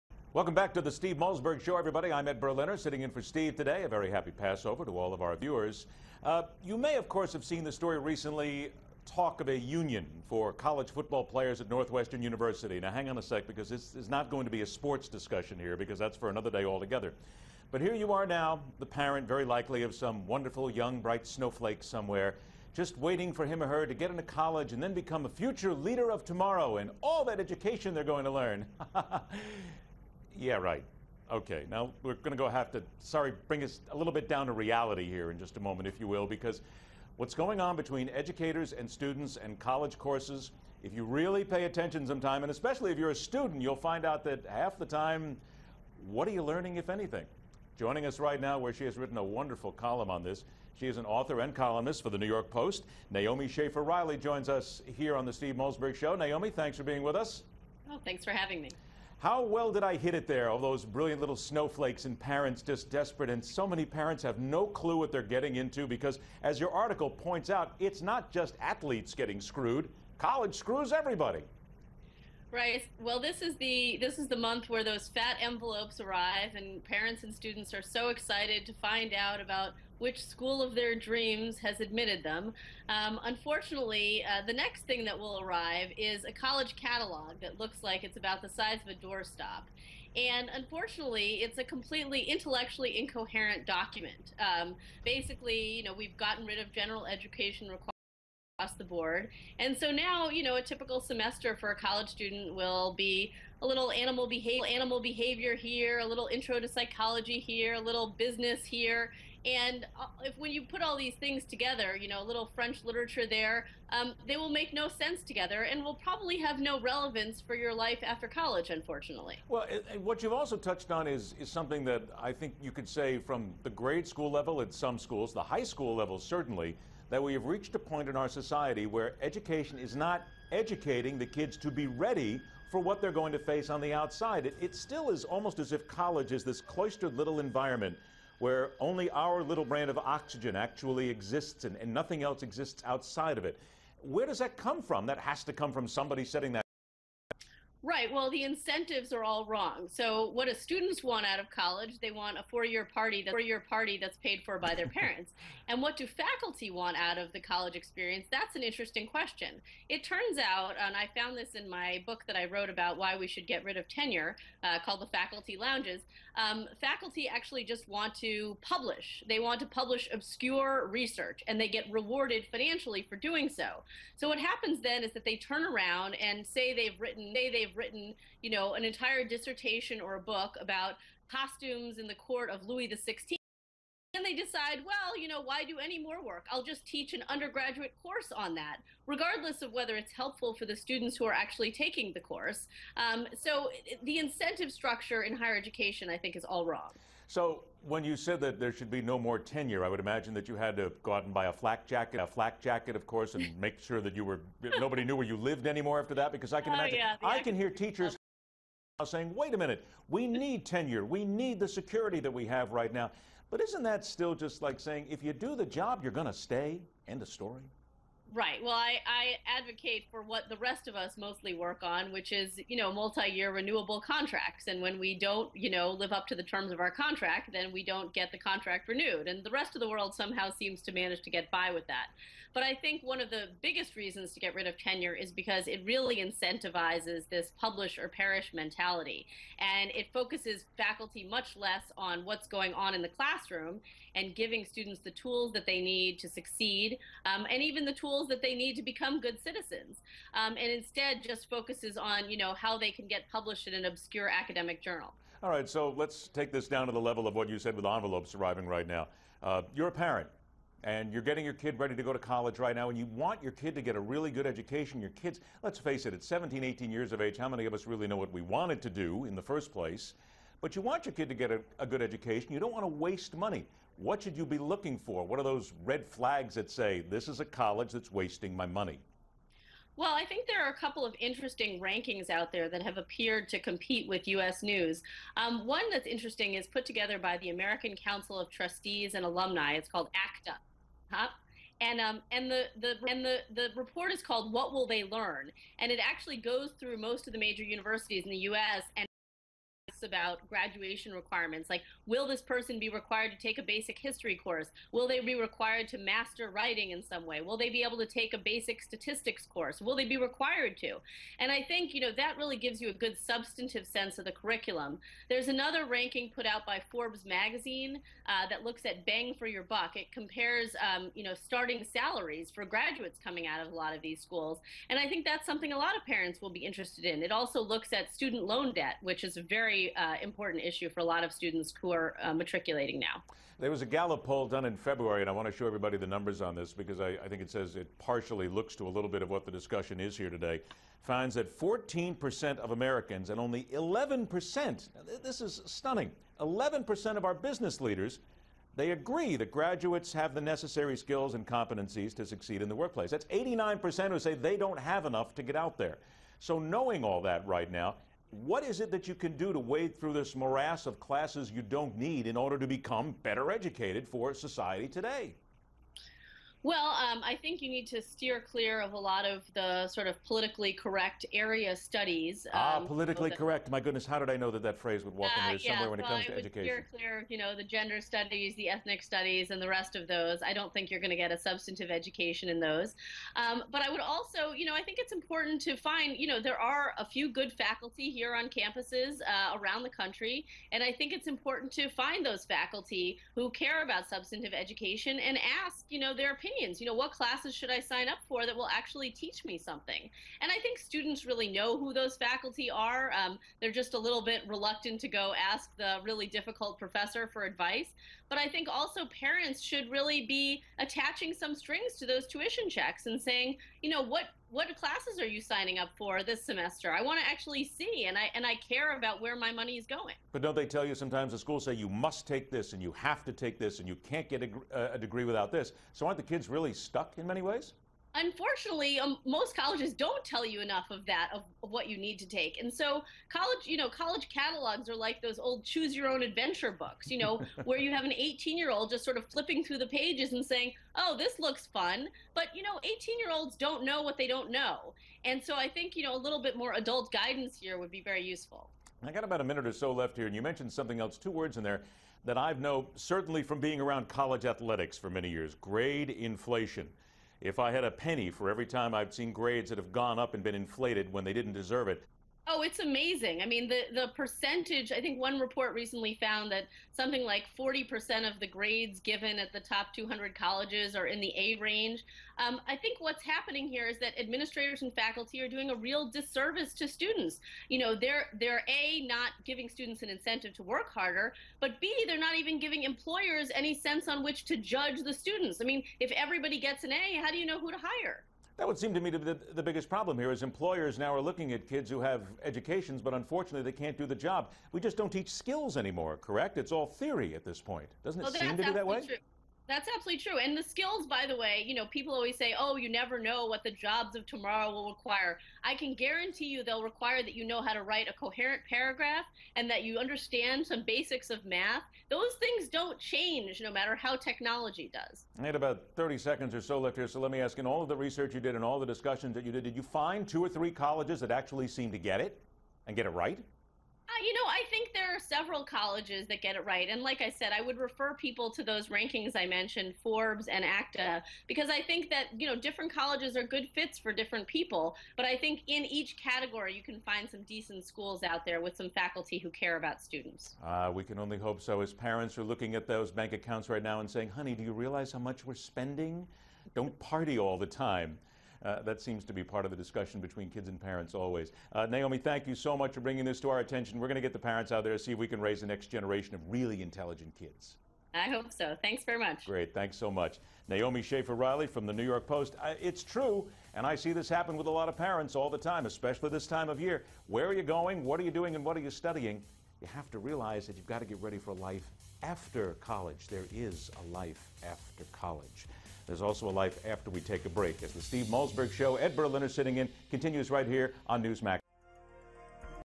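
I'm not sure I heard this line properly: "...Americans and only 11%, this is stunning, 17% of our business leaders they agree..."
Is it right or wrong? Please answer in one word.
wrong.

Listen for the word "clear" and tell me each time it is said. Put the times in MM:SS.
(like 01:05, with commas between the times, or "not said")
06:08, 06:16.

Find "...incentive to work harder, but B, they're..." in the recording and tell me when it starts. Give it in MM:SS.
08:00.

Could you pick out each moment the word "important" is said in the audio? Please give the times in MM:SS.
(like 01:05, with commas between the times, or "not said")
05:30, 06:25, 06:31.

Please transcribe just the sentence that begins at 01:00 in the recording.
All those brilliant little snowflakes and parents just desperate.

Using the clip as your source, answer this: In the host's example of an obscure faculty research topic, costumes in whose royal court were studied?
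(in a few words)
Louis XVI.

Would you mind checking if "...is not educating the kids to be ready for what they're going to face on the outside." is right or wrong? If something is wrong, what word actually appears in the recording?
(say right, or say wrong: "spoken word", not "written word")
right.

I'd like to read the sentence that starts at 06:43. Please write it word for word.
Um, they're just a little bit reluctant to go ask the really difficult professor for advice.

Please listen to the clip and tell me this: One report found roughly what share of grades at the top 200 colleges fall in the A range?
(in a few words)
40%.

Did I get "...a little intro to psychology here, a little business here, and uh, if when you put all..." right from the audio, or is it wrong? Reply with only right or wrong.
right.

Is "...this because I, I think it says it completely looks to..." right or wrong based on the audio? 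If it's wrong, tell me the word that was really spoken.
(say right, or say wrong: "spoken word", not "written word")
wrong: "partially", not "completely".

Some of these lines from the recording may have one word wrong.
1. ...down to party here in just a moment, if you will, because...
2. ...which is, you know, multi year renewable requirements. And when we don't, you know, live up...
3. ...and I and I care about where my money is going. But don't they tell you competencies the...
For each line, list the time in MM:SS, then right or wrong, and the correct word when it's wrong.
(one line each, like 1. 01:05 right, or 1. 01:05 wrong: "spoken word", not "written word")
1. 00:34 wrong: "reality", not "party"
2. 03:42 wrong: "contracts", not "requirements"
3. 06:58 wrong: "sometimes", not "competencies".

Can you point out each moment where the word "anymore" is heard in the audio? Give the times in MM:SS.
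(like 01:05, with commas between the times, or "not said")
03:25, 08:15.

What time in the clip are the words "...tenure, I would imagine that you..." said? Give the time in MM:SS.
03:19.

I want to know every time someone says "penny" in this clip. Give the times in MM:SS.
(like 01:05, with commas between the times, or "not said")
07:37.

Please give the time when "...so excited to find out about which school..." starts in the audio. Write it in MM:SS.
01:17.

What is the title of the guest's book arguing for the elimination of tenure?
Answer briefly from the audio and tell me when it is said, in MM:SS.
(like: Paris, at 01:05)
The Faculty Lounges, at 02:45.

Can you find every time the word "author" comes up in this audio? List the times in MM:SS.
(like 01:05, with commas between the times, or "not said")
00:51.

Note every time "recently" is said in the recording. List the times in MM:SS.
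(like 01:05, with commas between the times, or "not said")
00:07, 07:45.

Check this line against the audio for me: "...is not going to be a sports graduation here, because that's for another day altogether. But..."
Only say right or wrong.
wrong.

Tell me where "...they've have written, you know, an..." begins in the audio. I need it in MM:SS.
02:57.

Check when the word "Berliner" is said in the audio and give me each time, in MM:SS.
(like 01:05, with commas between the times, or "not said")
00:02, 09:39.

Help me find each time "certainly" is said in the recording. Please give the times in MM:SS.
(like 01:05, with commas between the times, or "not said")
02:06, 07:32.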